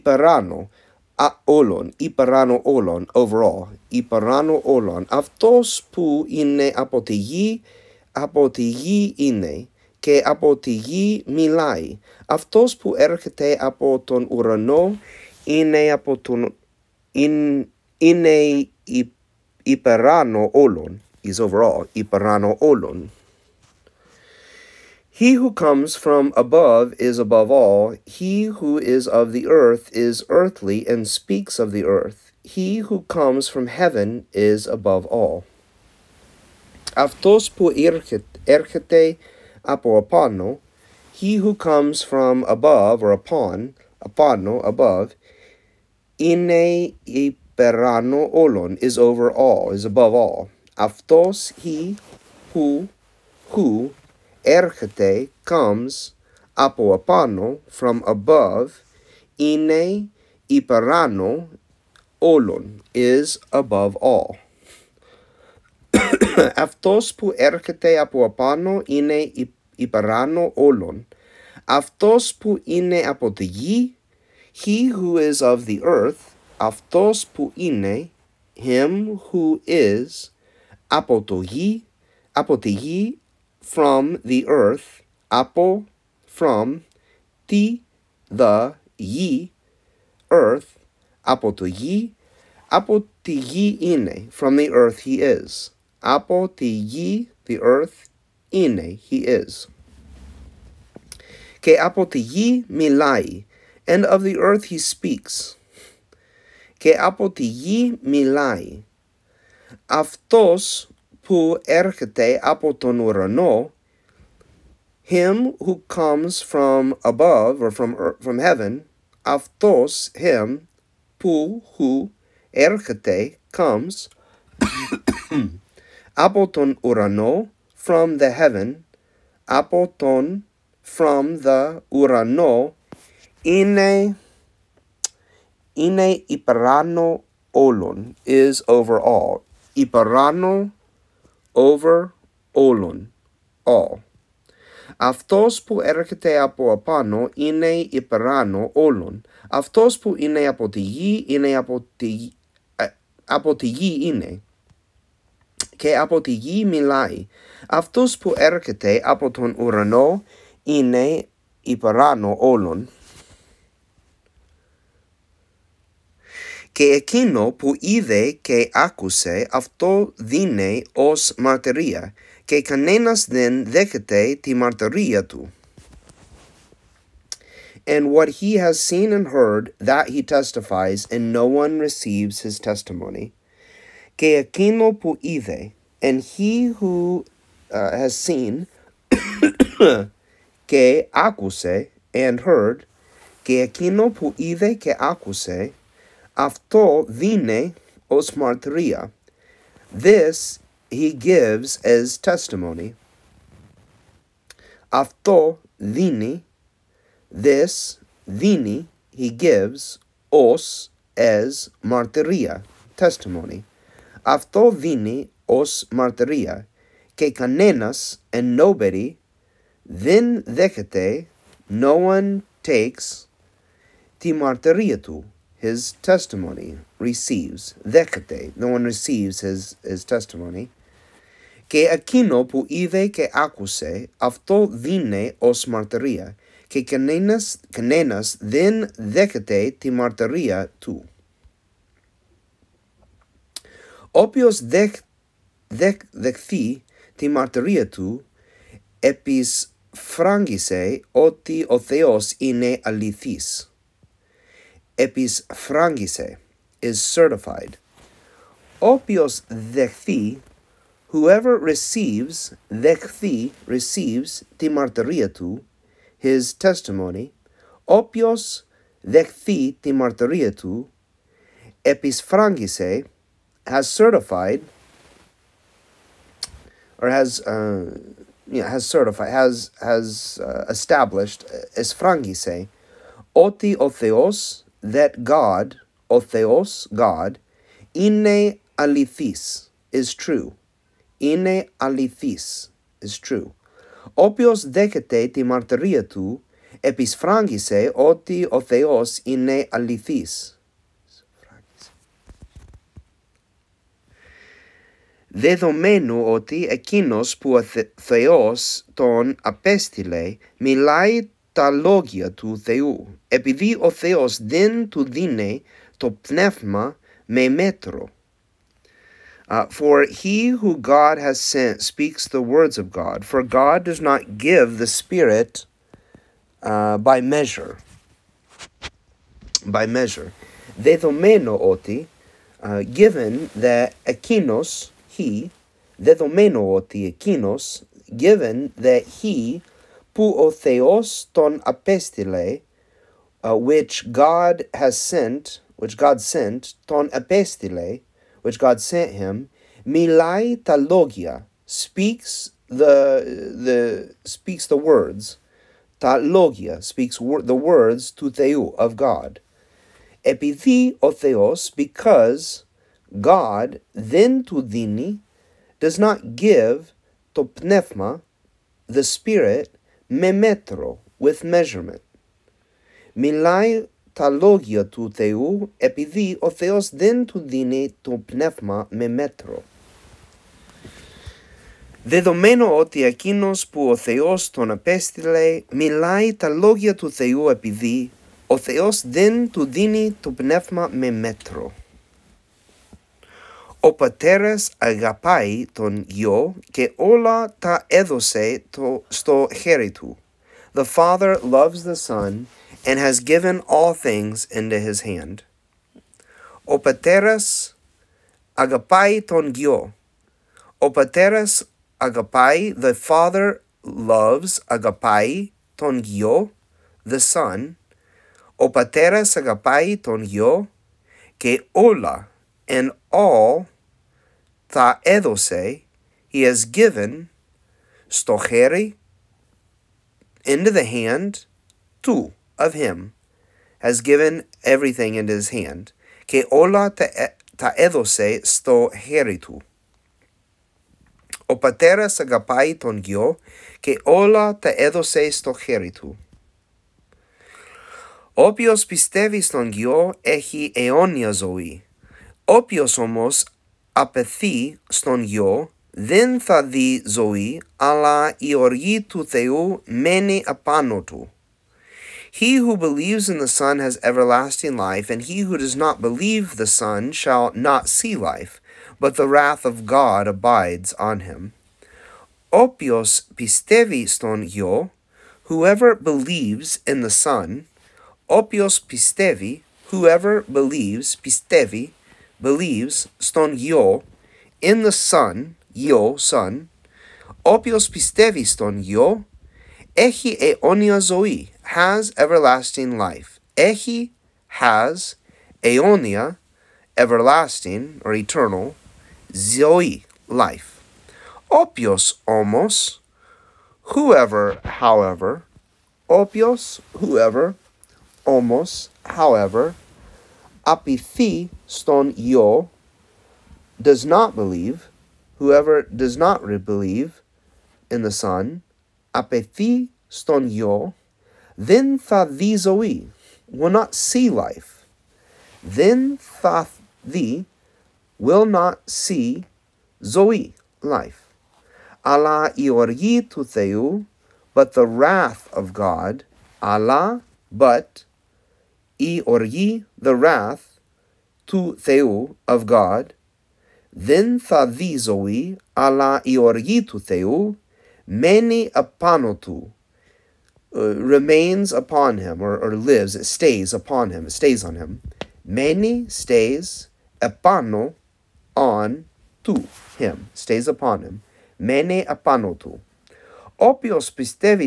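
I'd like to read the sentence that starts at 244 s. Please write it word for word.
Όποιος δεχ, δεχ, δεχθεί τη μαρτυρία του, επισφράγγισε ότι ο Θεός είναι αληθής.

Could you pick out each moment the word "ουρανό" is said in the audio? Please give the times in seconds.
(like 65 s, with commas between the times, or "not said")
14 s, 112 s, 126 s, 131 s, 159 s.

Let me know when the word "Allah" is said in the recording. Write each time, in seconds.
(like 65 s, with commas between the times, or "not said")
536 s.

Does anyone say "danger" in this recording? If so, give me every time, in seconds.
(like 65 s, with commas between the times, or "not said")
not said.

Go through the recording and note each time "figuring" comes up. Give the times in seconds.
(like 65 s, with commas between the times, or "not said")
not said.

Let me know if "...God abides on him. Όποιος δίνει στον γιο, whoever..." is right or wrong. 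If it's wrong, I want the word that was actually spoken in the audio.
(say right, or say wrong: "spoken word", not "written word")
wrong: "πιστεύει", not "δίνει".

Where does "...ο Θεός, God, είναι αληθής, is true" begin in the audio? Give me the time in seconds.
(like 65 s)
286 s.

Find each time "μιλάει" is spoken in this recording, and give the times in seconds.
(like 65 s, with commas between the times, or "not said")
11 s, 156 s, 310 s, 349 s, 373 s, 385 s.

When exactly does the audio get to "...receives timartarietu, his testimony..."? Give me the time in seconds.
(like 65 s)
263 s.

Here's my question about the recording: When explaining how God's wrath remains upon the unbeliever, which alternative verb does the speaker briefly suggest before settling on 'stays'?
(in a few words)
lives.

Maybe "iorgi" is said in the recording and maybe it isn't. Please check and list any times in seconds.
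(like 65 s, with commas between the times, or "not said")
532 s.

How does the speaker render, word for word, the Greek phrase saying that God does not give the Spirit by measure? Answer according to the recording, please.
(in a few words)
with measurement.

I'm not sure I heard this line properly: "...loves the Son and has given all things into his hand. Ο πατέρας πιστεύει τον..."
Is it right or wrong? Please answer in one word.
wrong.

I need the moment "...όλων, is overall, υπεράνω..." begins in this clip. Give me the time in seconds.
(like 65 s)
20 s.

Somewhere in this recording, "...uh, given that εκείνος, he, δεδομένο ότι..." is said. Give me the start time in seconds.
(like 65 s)
332 s.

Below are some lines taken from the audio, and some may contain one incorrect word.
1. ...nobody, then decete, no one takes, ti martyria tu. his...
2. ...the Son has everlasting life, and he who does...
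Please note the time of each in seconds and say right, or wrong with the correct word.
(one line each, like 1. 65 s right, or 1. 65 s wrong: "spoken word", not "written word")
1. 218 s right
2. 463 s right.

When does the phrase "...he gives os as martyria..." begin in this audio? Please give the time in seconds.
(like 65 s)
209 s.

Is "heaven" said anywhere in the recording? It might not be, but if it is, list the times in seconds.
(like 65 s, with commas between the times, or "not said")
33 s, 118 s, 128 s.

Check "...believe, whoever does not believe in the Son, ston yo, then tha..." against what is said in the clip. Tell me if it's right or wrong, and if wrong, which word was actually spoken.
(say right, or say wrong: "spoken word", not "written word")
right.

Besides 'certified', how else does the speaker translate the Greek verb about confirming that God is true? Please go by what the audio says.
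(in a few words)
established.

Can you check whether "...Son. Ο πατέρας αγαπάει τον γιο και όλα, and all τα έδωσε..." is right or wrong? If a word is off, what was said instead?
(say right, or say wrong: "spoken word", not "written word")
right.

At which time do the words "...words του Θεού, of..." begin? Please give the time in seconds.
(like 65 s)
357 s.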